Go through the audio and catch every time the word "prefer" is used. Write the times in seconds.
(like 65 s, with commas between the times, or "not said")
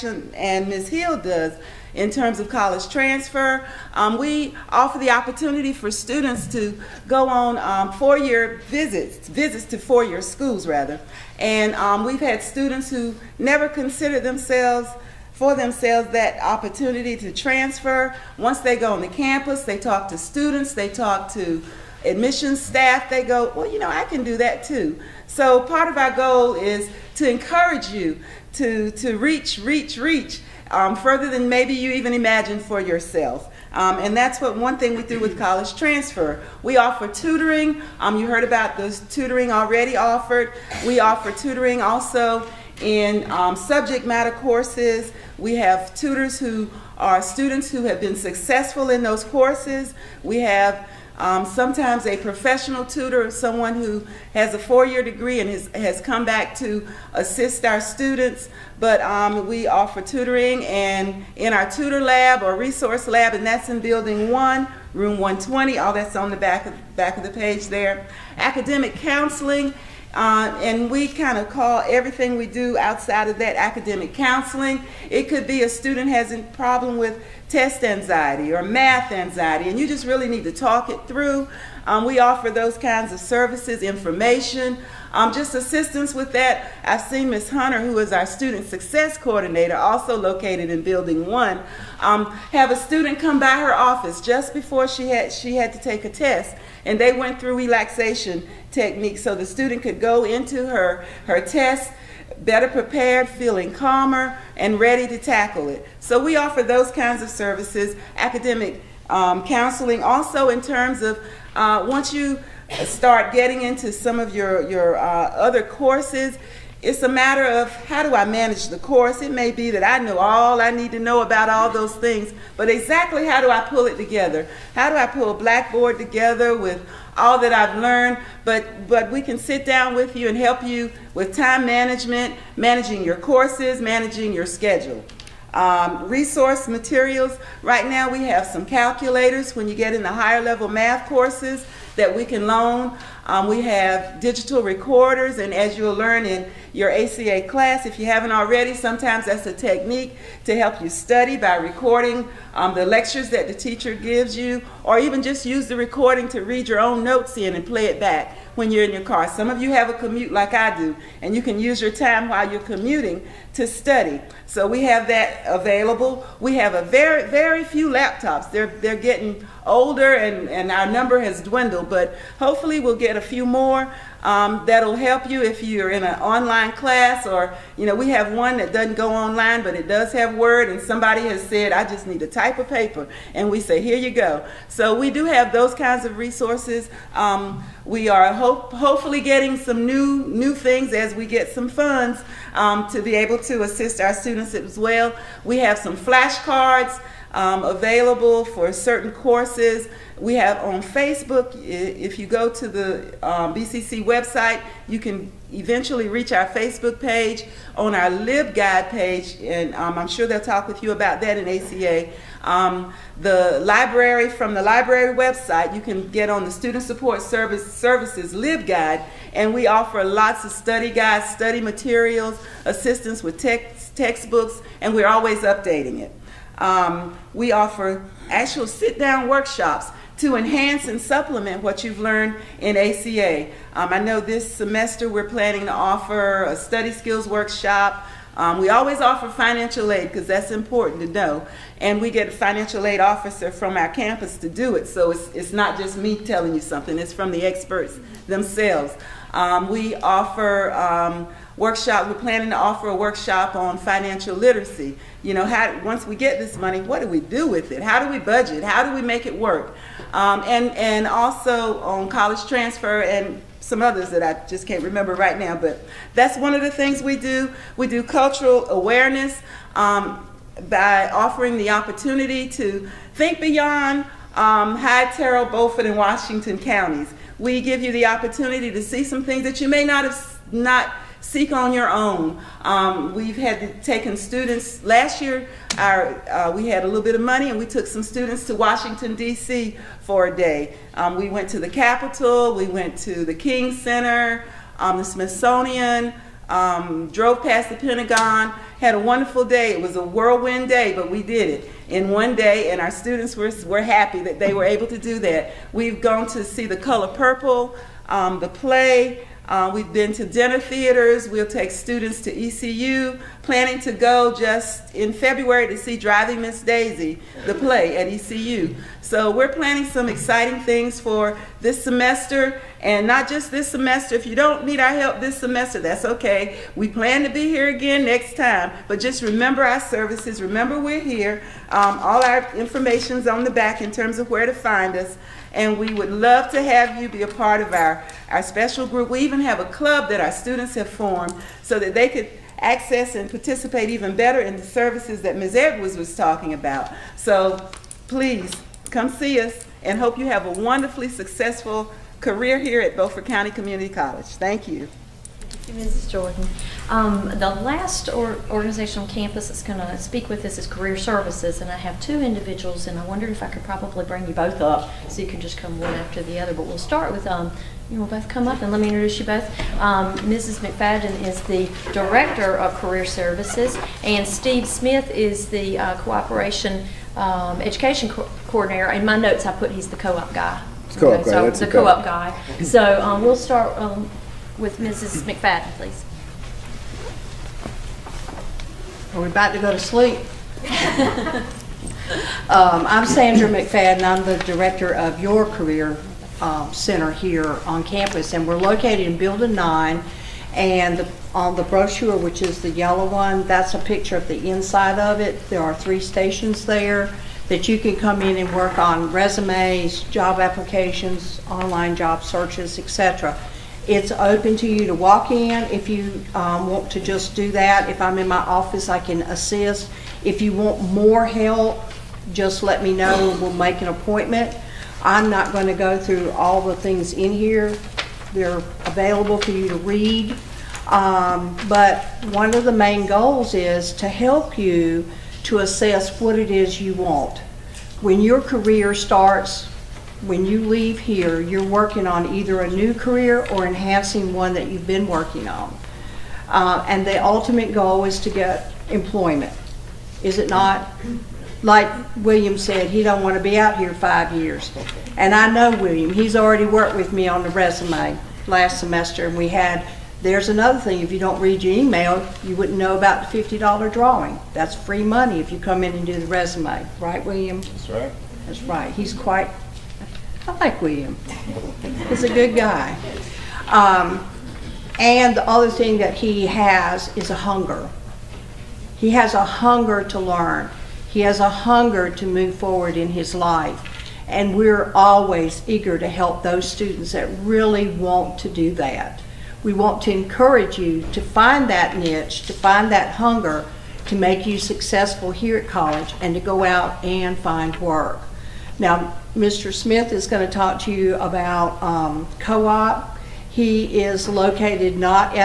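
not said.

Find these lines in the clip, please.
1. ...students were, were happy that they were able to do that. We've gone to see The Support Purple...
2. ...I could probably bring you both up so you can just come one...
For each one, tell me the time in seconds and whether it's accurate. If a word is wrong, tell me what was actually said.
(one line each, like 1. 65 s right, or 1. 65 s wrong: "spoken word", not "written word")
1. 302 s wrong: "Color", not "Support"
2. 363 s right.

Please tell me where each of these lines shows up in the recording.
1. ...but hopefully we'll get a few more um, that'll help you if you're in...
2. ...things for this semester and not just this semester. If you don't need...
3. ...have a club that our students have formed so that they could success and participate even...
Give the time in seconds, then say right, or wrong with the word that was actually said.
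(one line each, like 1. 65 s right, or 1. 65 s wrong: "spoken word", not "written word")
1. 171 s right
2. 320 s right
3. 339 s wrong: "access", not "success".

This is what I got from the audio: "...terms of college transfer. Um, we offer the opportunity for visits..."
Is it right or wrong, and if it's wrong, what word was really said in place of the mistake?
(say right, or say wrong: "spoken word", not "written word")
wrong: "students", not "visits".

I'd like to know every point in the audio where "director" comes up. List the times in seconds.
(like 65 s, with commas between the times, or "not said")
371 s, 394 s.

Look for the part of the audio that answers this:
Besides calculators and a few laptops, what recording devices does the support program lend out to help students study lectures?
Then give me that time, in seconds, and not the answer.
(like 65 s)
144 s.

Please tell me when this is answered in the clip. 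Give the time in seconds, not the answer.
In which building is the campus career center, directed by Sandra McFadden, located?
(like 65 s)
399 s.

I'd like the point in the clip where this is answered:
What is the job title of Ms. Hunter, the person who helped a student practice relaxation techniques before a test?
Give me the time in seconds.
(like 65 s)
88 s.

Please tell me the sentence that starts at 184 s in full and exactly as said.
So we do have those kinds of resources.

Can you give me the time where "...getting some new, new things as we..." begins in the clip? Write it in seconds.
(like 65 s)
189 s.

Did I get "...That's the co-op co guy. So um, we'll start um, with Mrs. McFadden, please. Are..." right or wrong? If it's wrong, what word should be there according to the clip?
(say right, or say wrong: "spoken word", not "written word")
right.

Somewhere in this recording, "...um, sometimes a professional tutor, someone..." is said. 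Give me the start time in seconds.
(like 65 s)
51 s.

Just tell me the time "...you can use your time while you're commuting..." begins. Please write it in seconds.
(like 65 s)
161 s.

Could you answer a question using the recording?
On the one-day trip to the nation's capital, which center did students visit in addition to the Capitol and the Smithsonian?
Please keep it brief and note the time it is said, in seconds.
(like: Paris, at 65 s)
the King Center, at 293 s.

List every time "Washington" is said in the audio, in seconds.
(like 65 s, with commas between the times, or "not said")
275 s, 288 s.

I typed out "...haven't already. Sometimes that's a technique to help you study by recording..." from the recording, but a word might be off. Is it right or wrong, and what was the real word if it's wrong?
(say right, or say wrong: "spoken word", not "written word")
right.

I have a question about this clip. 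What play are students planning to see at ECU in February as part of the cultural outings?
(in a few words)
Driving Miss Daisy.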